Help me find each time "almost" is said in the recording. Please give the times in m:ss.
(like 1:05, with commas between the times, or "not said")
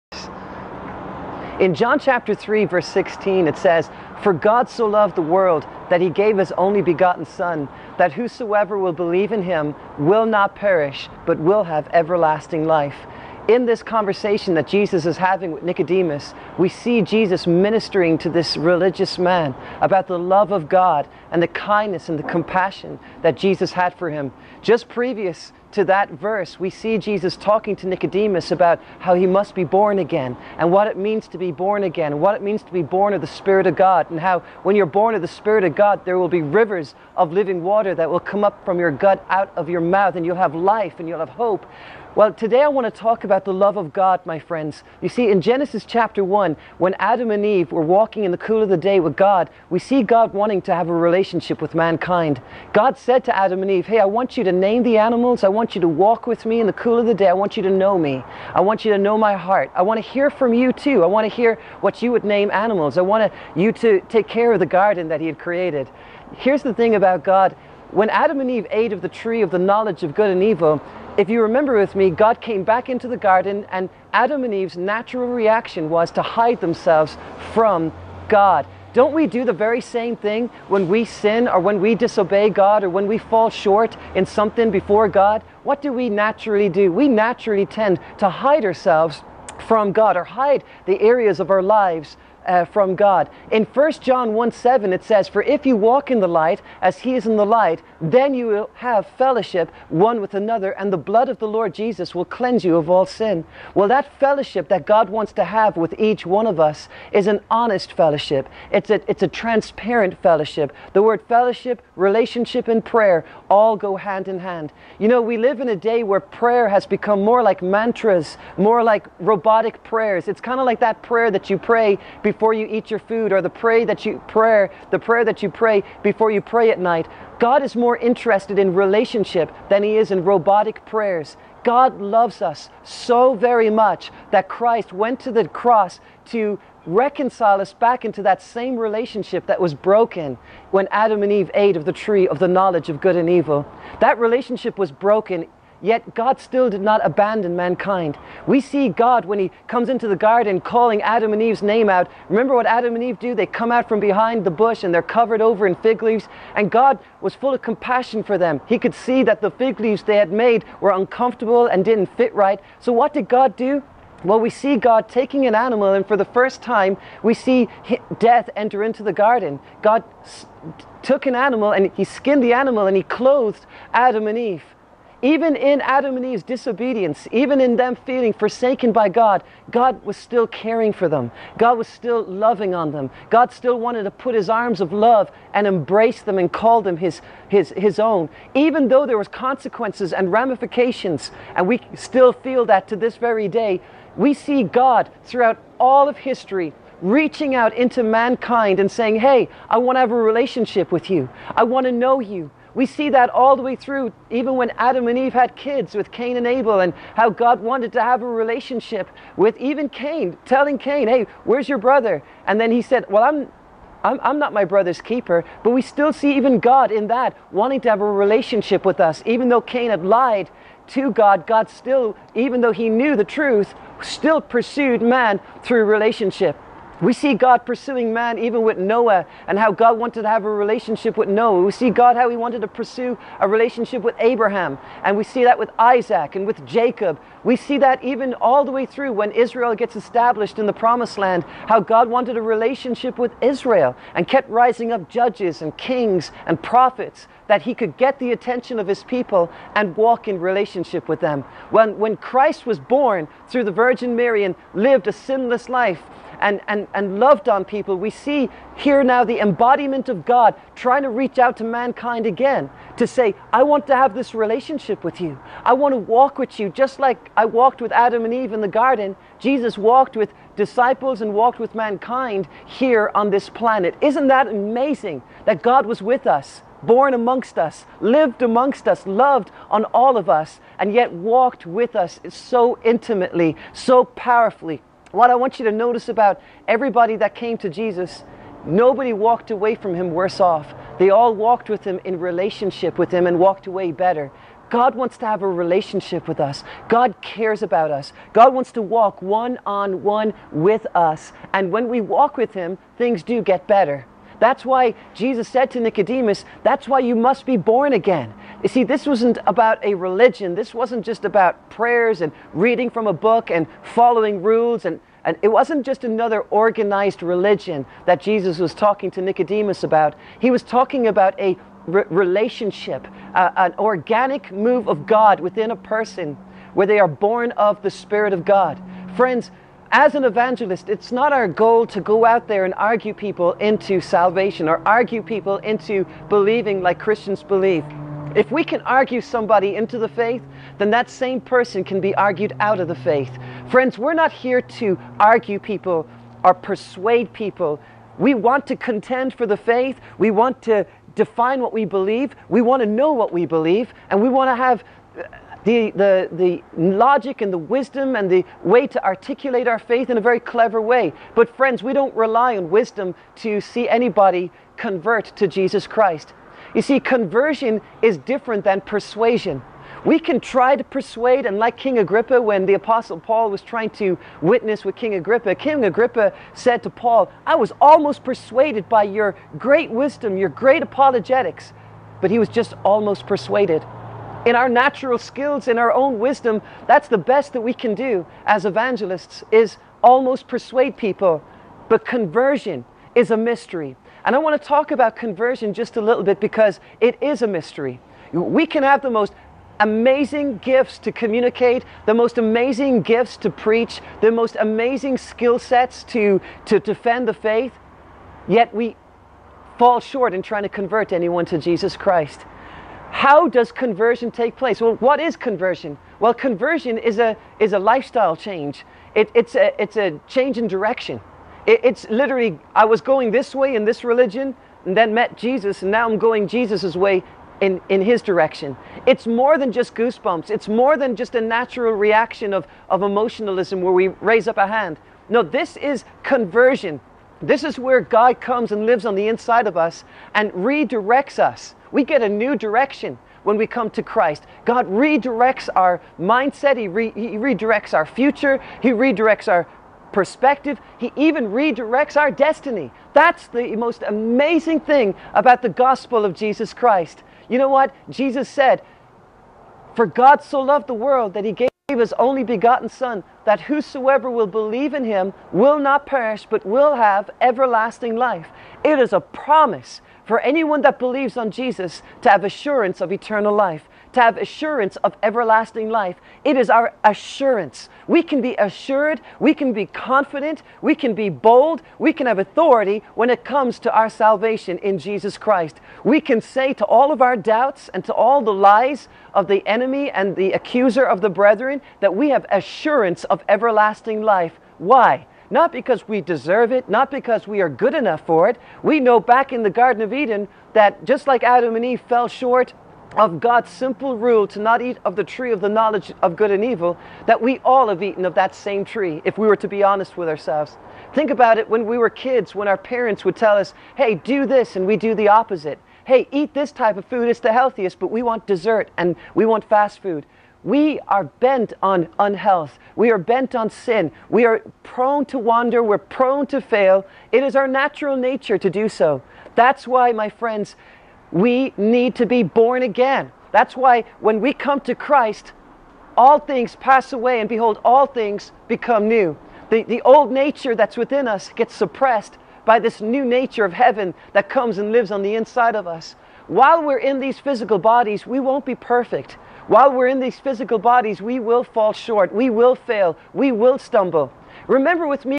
6:17, 6:22, 6:30.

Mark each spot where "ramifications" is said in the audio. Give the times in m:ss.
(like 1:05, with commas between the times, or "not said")
3:10.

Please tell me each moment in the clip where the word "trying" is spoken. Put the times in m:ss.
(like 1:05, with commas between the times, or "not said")
4:20, 6:13, 6:50.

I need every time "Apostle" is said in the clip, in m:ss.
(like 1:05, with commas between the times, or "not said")
6:12.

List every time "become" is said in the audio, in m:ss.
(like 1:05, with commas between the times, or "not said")
1:56, 8:58.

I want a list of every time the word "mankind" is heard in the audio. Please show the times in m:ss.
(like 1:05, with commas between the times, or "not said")
0:51, 2:27, 3:18, 4:21, 4:31.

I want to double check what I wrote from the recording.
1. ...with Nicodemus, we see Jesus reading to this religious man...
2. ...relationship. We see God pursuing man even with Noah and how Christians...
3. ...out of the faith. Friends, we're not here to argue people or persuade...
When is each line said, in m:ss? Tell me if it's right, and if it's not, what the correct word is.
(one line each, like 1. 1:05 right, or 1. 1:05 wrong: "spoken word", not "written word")
1. 0:15 wrong: "ministering", not "reading"
2. 3:45 wrong: "God", not "Christians"
3. 5:42 right.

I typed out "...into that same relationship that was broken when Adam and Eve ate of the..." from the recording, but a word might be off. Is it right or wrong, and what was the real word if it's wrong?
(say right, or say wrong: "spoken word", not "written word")
right.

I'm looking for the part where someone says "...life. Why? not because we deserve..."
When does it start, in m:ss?
8:14.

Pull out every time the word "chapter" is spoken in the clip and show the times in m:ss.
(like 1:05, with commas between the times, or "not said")
0:01, 0:45.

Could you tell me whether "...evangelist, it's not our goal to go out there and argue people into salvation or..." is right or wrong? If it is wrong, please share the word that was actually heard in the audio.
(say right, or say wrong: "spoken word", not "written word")
right.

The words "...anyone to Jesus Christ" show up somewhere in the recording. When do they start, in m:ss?
6:51.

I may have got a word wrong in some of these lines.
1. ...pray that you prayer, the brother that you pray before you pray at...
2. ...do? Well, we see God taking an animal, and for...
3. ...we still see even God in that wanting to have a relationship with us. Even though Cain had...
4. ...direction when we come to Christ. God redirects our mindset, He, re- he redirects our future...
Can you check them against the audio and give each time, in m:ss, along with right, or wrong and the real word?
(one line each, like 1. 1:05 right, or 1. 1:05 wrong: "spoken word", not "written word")
1. 2:03 wrong: "prayer", not "brother"
2. 2:43 right
3. 3:35 right
4. 7:22 right.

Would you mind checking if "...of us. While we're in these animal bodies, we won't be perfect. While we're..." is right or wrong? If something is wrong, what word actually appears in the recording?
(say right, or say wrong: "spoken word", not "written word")
wrong: "physical", not "animal".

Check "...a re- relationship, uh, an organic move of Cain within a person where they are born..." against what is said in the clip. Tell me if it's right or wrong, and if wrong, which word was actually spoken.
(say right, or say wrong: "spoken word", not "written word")
wrong: "God", not "Cain".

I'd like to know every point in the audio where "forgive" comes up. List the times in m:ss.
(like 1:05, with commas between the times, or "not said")
not said.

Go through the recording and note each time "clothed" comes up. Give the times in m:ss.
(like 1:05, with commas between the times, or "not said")
2:53.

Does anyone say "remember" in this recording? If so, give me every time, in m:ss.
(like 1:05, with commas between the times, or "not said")
1:11, 2:32, 9:14.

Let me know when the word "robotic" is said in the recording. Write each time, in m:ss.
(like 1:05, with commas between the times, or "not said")
1:59, 2:10.